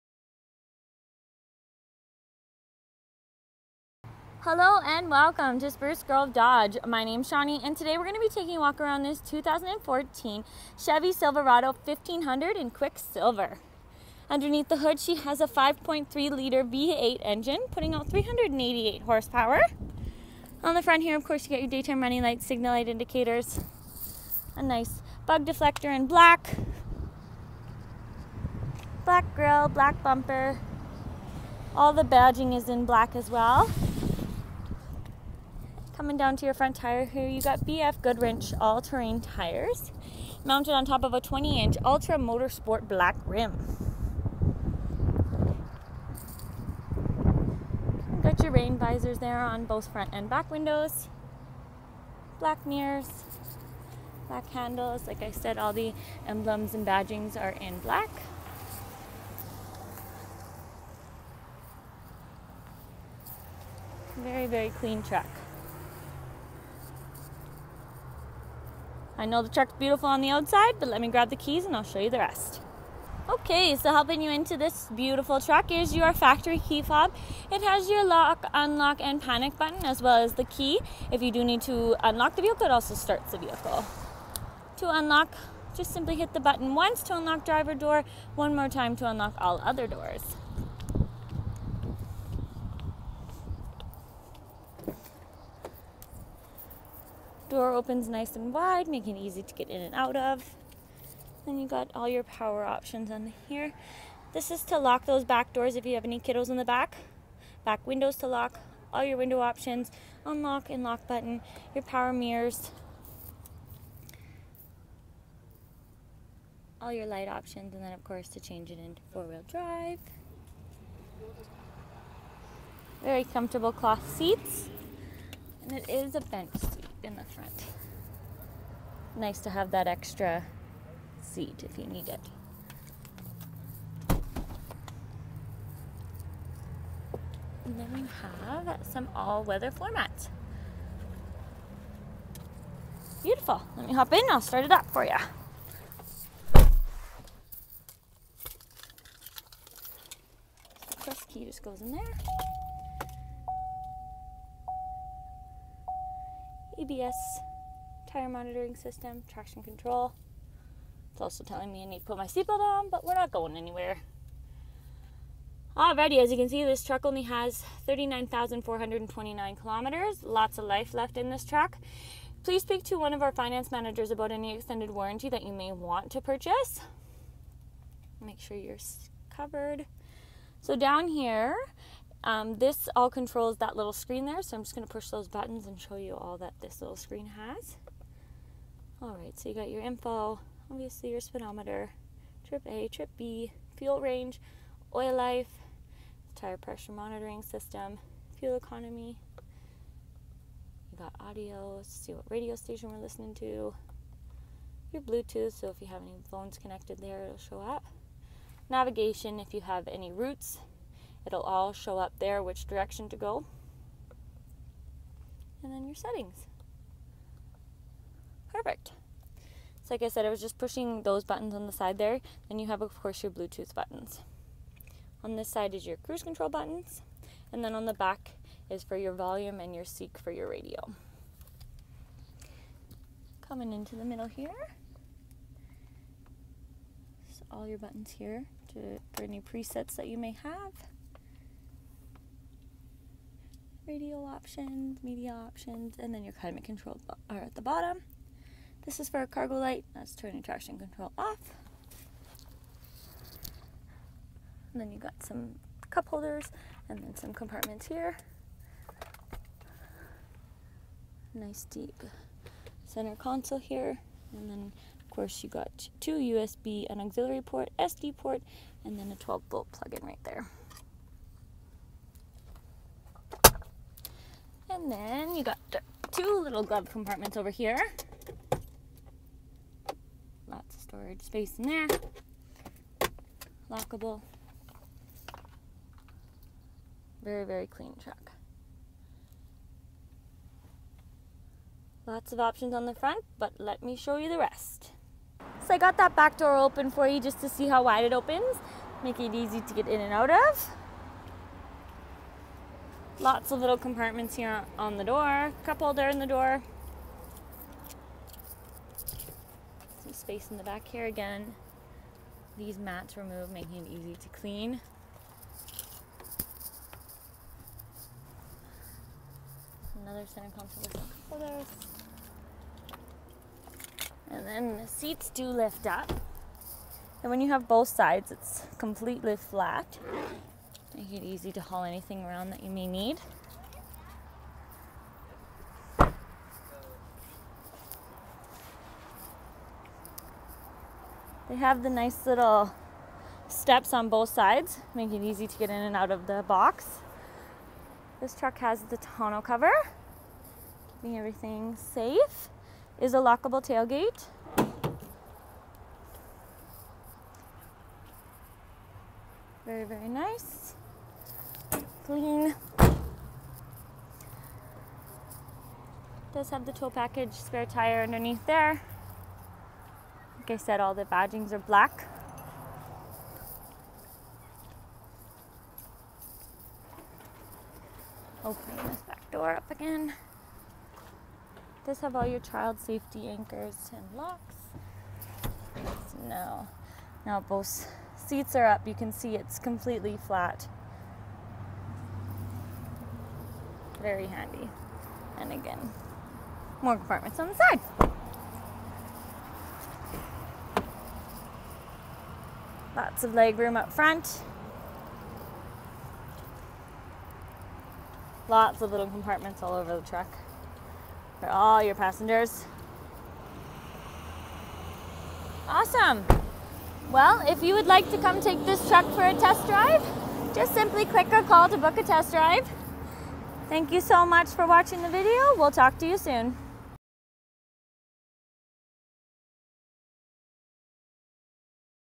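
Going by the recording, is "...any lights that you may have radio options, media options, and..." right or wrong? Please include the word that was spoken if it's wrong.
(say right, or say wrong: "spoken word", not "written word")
wrong: "presets", not "lights".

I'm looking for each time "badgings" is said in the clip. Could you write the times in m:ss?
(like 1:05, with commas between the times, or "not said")
0:32, 0:56, 6:11.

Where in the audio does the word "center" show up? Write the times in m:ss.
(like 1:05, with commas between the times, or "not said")
4:22, 5:20.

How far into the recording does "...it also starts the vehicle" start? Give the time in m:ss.
1:22.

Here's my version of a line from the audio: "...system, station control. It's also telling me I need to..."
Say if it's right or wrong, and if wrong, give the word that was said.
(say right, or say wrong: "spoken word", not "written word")
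wrong: "traction", not "station".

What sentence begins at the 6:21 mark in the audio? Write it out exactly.
Does have all your child safety anchors and locks.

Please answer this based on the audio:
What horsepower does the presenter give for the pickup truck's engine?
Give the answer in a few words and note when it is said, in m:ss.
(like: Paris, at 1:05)
388, at 0:18.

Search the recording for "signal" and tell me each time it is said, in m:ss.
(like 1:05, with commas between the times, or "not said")
0:22.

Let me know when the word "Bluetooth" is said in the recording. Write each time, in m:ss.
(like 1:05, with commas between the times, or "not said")
3:25, 3:43.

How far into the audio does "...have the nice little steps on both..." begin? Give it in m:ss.
5:41.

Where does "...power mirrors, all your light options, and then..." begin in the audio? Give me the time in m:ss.
1:51.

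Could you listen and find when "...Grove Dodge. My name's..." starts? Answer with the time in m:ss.
0:06.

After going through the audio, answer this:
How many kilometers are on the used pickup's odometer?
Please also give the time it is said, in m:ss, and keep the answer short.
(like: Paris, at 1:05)
39,429, at 2:47.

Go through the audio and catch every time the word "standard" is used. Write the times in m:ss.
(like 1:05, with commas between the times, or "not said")
not said.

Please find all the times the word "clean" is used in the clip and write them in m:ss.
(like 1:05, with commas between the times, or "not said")
1:04, 4:47, 5:14, 6:02.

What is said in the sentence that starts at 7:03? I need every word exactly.
Thank you so much for watching the video.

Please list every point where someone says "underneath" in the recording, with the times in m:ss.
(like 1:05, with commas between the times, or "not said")
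0:14, 6:08.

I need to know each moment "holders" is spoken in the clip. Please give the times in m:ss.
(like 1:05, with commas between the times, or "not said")
4:16, 5:21.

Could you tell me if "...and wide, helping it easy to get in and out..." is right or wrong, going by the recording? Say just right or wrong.
wrong.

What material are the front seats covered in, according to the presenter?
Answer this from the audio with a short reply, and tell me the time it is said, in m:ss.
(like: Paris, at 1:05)
Cloth, at 2:03.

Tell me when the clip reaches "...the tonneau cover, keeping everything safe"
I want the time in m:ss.
5:48.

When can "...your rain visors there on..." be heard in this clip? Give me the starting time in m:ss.
0:48.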